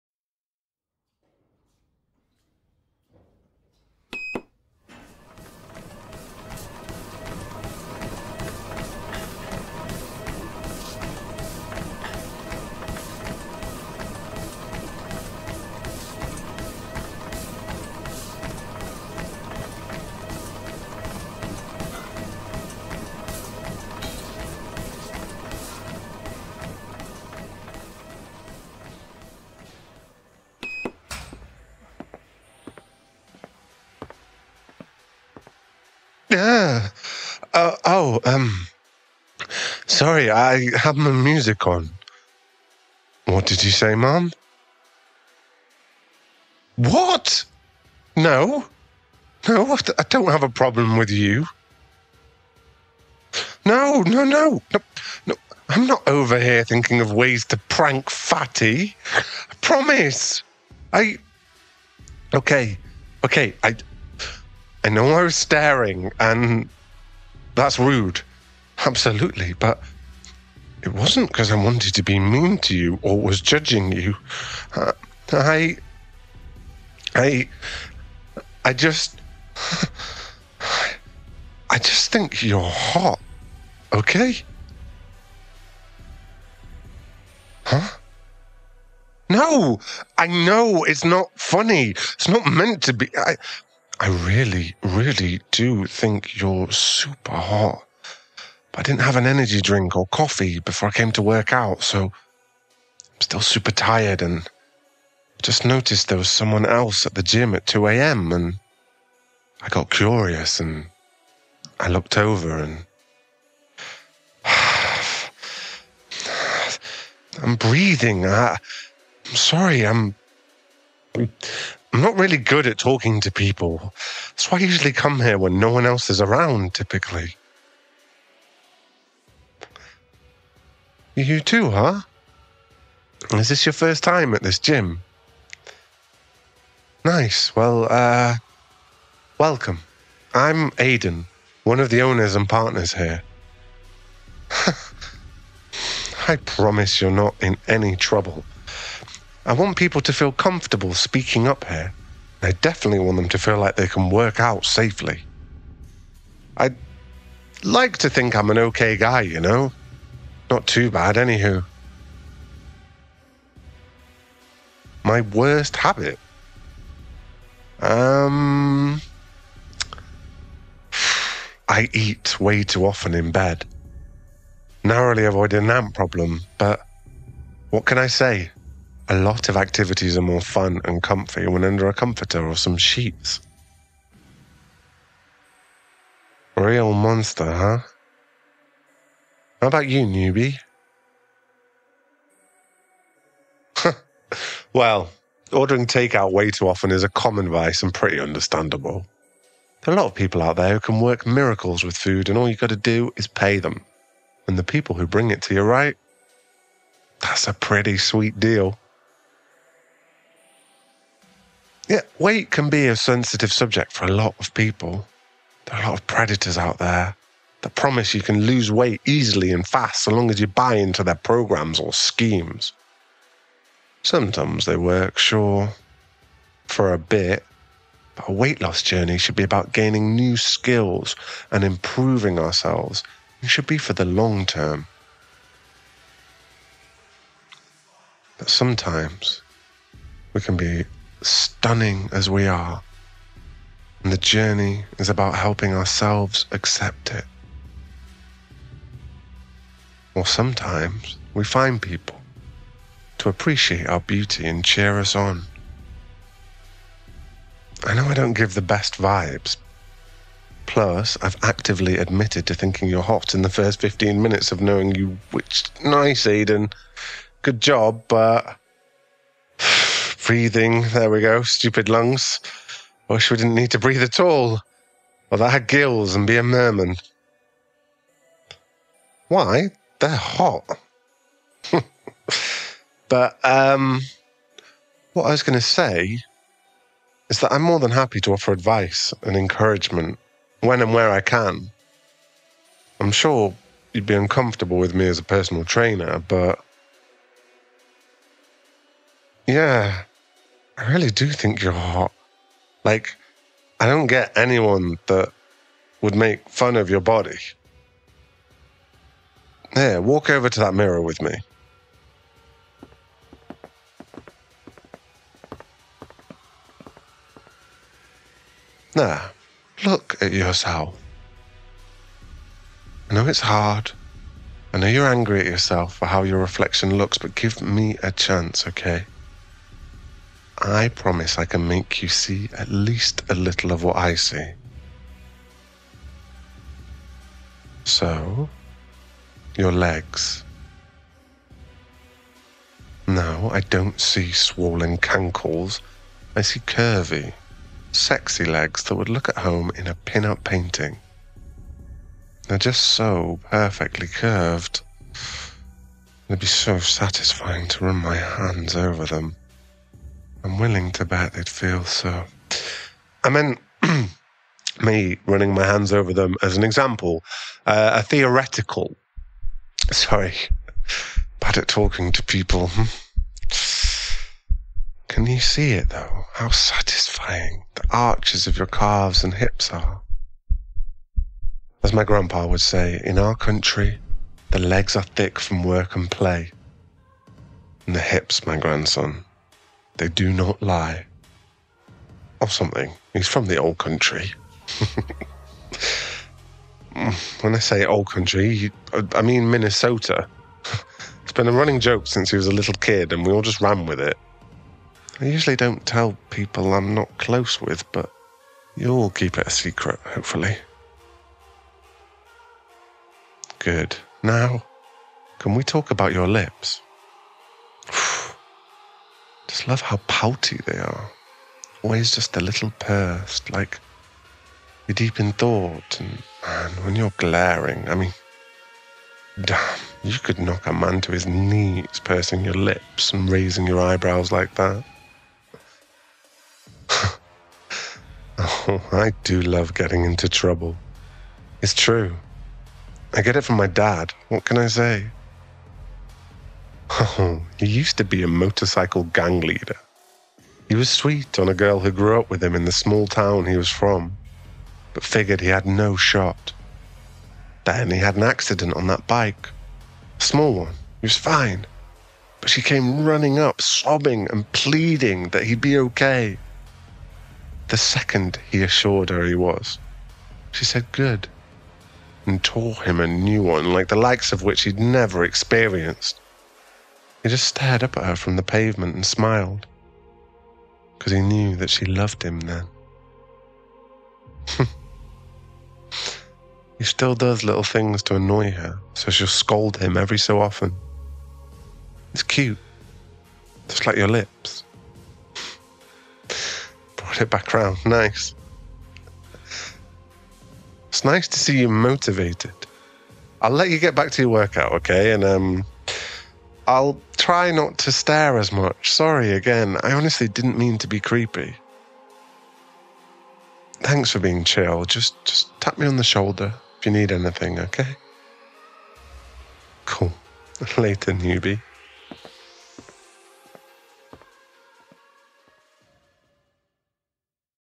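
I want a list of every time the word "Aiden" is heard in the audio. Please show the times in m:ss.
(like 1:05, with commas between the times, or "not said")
2:20, 4:26.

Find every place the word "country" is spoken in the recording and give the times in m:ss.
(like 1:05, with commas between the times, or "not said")
6:23, 6:33, 6:38.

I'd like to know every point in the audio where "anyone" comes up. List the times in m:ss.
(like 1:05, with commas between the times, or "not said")
5:04.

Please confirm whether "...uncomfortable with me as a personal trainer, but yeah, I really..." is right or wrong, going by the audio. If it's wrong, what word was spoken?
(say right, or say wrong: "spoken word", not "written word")
right.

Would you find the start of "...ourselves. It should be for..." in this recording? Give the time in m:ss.
3:52.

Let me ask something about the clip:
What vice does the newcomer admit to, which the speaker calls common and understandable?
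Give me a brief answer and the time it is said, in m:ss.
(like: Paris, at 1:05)
Ordering takeout, at 3:15.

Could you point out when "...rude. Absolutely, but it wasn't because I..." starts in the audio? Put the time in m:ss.
1:07.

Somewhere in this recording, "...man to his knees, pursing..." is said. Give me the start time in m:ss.
7:10.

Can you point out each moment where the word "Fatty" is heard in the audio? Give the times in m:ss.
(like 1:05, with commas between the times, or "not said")
0:58.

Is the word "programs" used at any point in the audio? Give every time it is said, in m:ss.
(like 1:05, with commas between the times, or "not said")
3:41.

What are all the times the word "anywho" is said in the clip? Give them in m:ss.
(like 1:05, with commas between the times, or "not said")
2:41.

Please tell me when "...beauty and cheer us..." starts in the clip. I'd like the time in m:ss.
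4:13.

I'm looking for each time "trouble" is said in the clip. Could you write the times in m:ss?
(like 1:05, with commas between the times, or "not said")
2:27, 7:20.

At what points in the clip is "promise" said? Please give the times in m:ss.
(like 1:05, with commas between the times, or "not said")
0:59, 2:26, 3:37, 5:30.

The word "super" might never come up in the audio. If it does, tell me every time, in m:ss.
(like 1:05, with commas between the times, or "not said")
1:36, 1:43.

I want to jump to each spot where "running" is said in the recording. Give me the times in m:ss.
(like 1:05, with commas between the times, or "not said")
6:05, 6:41, 7:43.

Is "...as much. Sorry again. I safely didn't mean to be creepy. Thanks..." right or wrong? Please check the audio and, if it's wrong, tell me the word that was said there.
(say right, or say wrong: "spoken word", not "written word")
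wrong: "honestly", not "safely".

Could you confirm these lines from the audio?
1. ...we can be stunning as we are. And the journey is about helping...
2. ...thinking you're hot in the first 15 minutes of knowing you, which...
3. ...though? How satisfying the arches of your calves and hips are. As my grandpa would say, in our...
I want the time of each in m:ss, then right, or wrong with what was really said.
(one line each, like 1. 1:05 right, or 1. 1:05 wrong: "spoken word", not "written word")
1. 4:00 right
2. 4:22 right
3. 6:15 right.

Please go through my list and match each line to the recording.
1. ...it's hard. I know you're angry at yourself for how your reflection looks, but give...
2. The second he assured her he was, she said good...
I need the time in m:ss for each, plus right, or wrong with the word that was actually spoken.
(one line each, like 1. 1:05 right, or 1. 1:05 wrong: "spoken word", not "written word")
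1. 5:23 right
2. 7:47 right.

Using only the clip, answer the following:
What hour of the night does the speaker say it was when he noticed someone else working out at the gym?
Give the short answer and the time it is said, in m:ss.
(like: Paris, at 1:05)
2 a.m., at 1:47.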